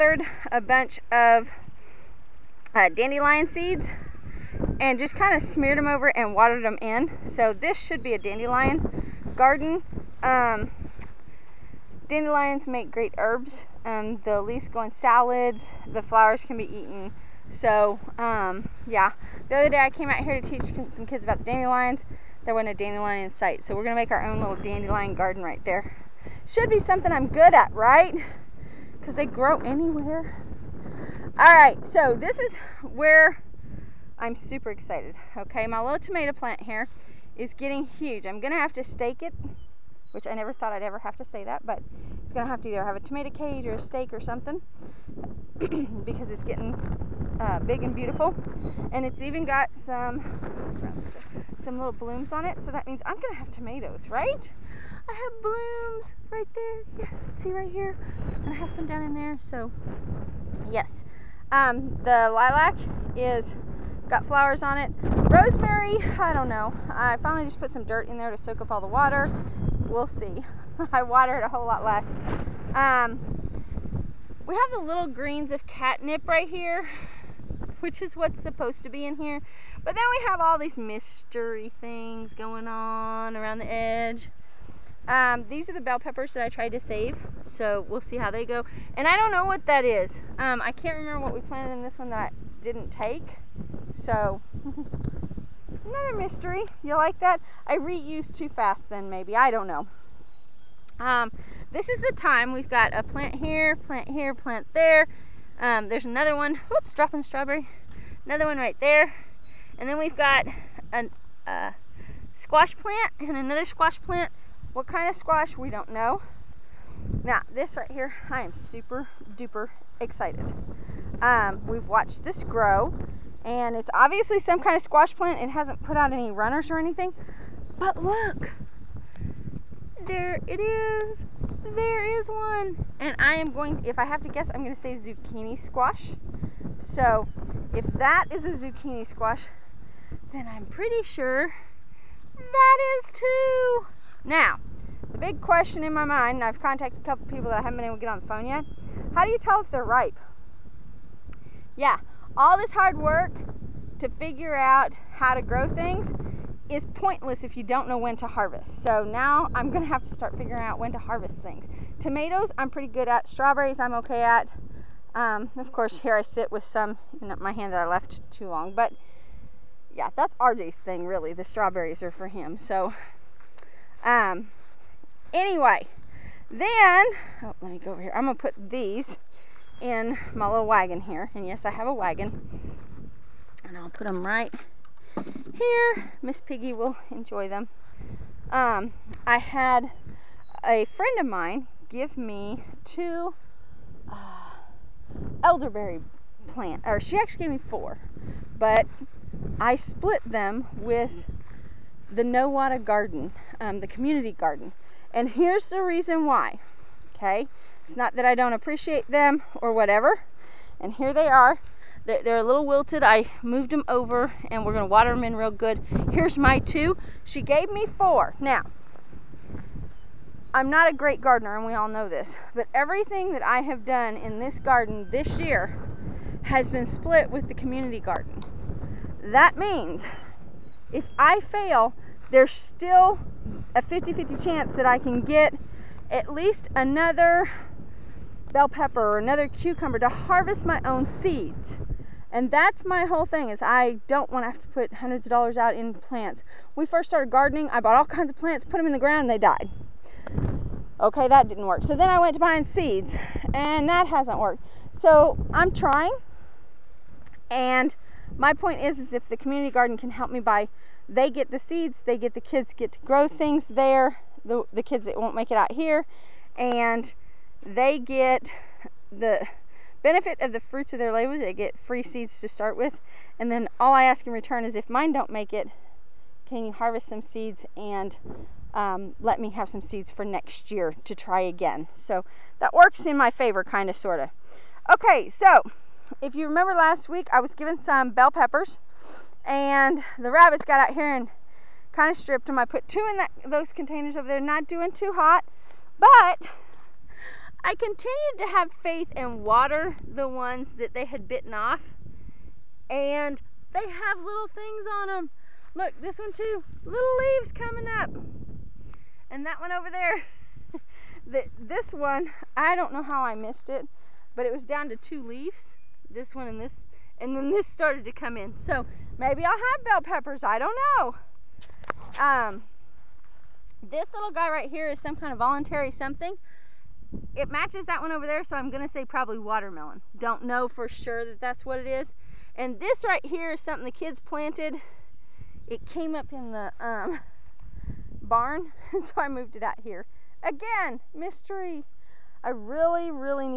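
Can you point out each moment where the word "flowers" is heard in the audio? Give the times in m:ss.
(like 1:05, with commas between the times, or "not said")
0:16, 1:04.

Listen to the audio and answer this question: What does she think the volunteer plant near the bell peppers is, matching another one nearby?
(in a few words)
Watermelon.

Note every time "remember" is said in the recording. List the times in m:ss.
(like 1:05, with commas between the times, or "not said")
1:30, 4:46.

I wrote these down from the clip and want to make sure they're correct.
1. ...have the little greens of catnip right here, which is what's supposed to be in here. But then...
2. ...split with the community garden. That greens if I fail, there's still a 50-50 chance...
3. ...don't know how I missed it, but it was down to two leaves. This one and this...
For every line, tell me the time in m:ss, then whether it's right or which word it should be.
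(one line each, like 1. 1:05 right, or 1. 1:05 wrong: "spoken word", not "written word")
1. 1:14 right
2. 3:46 wrong: "means", not "greens"
3. 5:12 right.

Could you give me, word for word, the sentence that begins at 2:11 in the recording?
There is one, and I am going.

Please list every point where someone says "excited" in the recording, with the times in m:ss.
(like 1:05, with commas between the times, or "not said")
0:34, 2:00.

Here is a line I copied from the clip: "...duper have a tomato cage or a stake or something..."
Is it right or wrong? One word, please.
wrong.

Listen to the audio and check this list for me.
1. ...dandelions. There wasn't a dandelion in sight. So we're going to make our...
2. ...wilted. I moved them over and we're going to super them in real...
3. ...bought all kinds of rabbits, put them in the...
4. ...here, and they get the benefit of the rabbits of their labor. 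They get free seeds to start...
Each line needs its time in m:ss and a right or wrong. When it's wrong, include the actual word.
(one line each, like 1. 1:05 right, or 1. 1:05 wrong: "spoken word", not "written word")
1. 0:21 right
2. 3:32 wrong: "water", not "super"
3. 4:07 wrong: "plants", not "rabbits"
4. 4:25 wrong: "fruits", not "rabbits".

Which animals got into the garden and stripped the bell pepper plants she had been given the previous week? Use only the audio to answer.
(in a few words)
Rabbits.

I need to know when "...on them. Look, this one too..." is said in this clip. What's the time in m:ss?
5:05.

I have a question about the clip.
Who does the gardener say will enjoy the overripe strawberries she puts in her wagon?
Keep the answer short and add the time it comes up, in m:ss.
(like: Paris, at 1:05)
Miss Piggy, at 3:06.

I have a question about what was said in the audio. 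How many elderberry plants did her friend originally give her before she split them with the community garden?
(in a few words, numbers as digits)
4.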